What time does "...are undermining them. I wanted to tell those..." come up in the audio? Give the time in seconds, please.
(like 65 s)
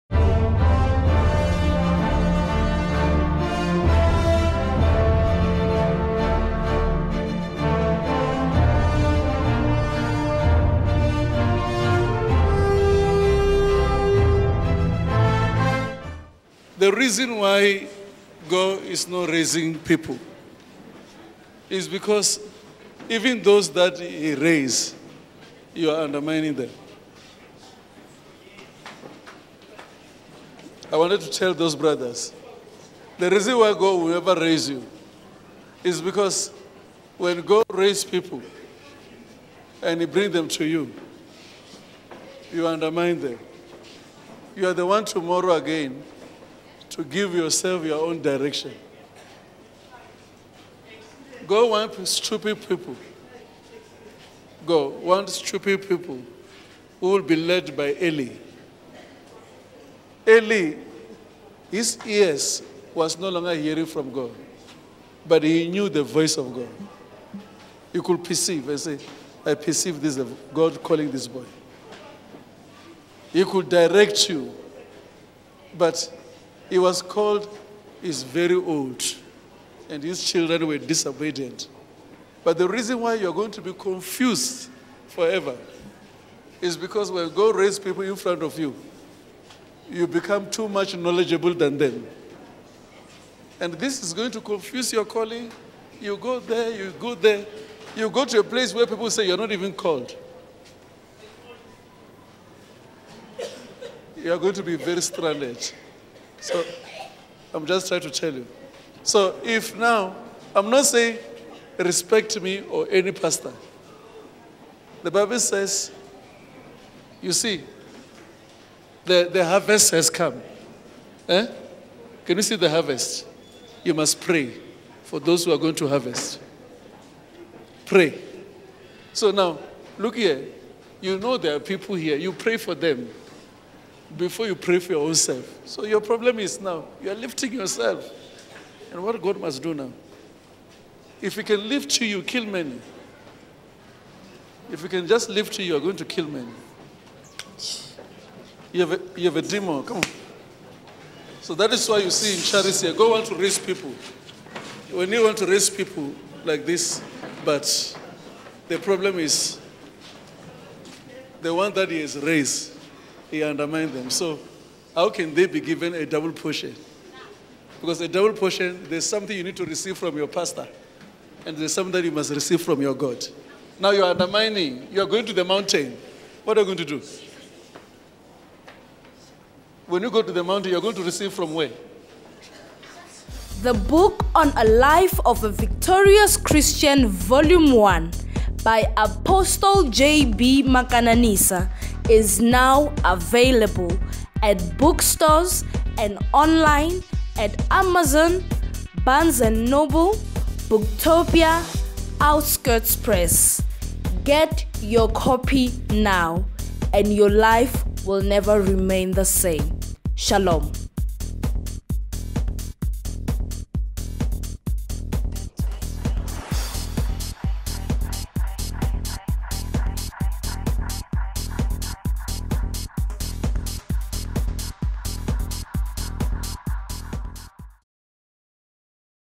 25 s.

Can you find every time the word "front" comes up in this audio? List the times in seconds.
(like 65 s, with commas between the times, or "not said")
88 s.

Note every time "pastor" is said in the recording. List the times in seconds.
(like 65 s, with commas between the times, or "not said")
113 s, 170 s.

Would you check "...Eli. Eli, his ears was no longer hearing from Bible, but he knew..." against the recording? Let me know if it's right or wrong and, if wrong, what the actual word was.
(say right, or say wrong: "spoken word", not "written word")
wrong: "God", not "Bible".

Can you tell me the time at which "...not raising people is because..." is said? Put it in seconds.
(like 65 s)
19 s.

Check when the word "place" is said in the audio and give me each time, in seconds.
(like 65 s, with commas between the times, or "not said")
98 s.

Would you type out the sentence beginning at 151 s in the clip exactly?
So that is why you see in charity, God go want to raise people.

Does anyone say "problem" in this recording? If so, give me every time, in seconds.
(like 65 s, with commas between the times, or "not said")
136 s, 158 s.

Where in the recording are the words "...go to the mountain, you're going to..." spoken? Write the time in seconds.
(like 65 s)
180 s.